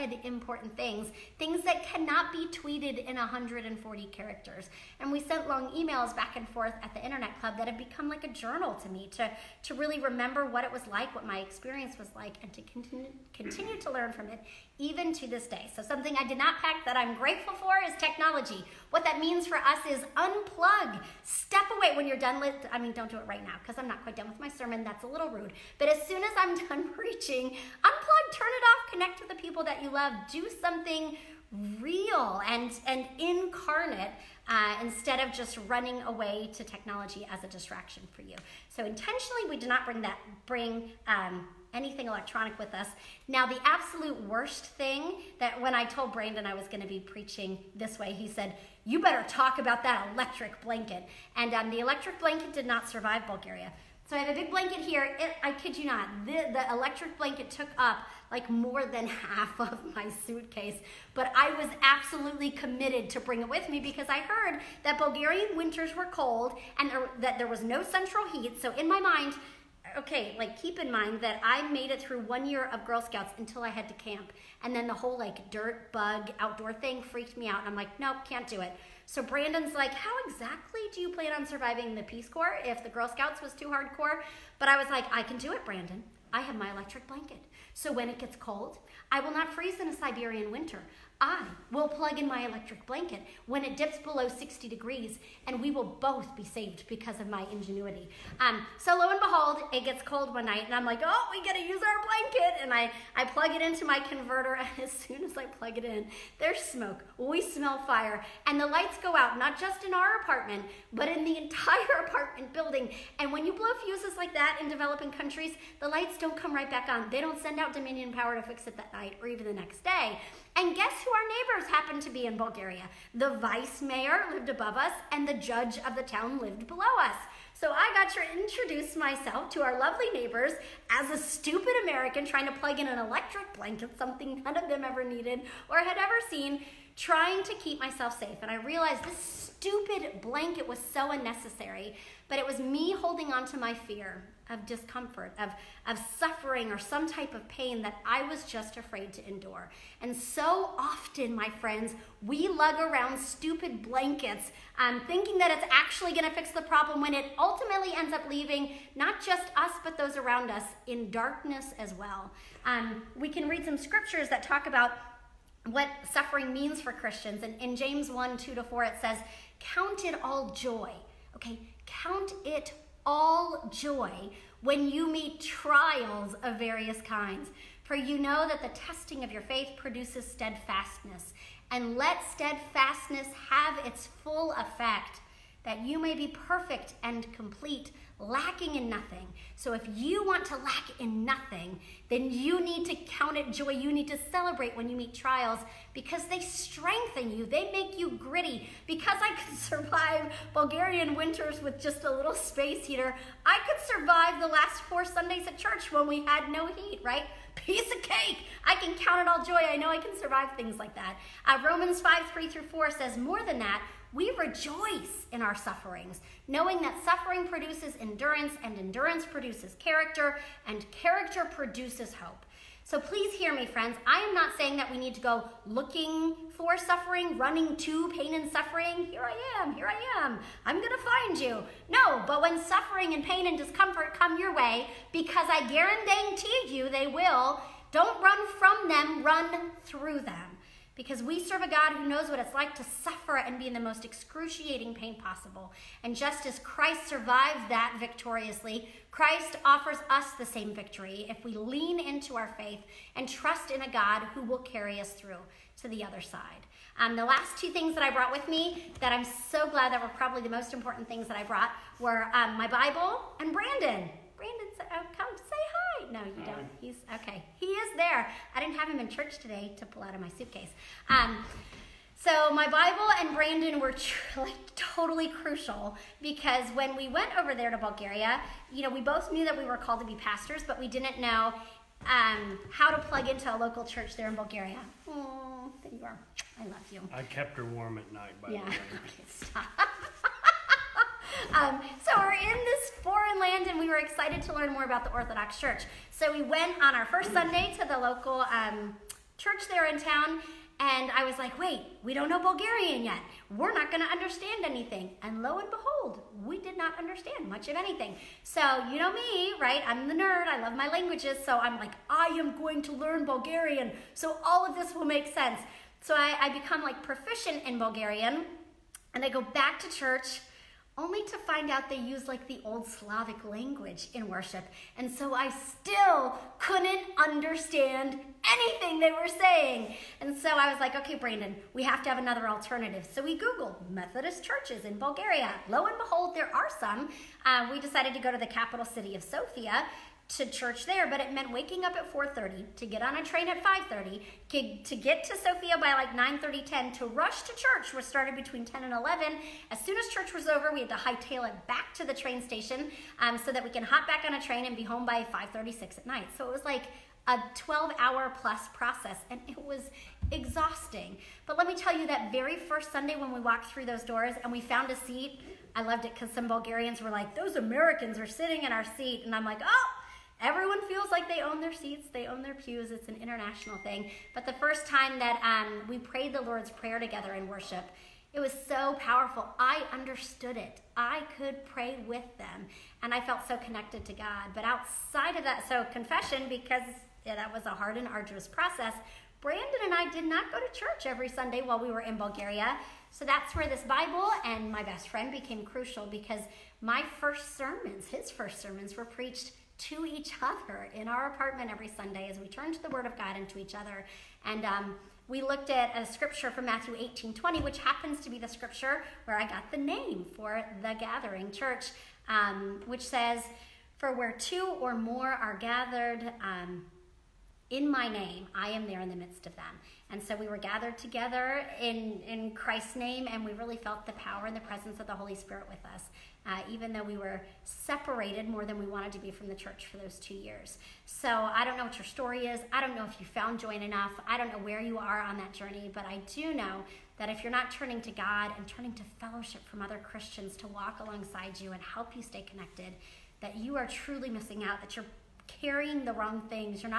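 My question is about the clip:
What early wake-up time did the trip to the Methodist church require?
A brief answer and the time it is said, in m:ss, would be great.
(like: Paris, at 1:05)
4:30, at 5:42.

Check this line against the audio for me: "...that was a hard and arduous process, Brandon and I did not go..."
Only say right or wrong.
right.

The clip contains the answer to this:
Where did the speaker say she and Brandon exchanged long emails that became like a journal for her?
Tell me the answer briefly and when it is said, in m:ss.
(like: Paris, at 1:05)
Internet Club, at 0:07.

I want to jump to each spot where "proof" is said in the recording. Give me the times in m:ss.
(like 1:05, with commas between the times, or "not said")
not said.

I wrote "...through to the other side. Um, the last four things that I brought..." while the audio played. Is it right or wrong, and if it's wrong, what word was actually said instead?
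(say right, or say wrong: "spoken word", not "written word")
wrong: "two", not "four".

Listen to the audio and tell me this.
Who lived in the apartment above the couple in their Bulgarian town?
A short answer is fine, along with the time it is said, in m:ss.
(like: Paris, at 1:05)
the vice mayor, at 2:03.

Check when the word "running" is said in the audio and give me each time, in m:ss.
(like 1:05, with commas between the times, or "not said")
0:35, 3:47.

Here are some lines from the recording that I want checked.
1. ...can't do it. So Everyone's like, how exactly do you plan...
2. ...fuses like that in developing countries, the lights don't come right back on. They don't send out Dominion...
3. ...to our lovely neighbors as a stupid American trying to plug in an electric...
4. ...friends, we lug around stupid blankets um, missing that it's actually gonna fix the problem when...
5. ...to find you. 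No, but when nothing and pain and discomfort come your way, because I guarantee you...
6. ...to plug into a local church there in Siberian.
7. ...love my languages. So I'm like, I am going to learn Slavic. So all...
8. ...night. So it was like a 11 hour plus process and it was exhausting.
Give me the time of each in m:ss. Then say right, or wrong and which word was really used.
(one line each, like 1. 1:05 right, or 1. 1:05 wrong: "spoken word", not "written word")
1. 1:18 wrong: "Brandon", not "Everyone"
2. 1:53 right
3. 2:09 right
4. 2:31 wrong: "thinking", not "missing"
5. 3:50 wrong: "suffering", not "nothing"
6. 4:42 wrong: "Bulgaria", not "Siberian"
7. 5:10 wrong: "Bulgarian", not "Slavic"
8. 5:56 wrong: "12", not "11".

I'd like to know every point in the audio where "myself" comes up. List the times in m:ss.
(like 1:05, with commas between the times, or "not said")
2:08, 2:17.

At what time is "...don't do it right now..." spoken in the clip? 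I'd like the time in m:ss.
0:22.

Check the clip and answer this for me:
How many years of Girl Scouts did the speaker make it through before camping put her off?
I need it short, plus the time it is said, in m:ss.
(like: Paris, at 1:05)
1, at 1:12.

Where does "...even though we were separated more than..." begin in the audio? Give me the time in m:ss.
7:06.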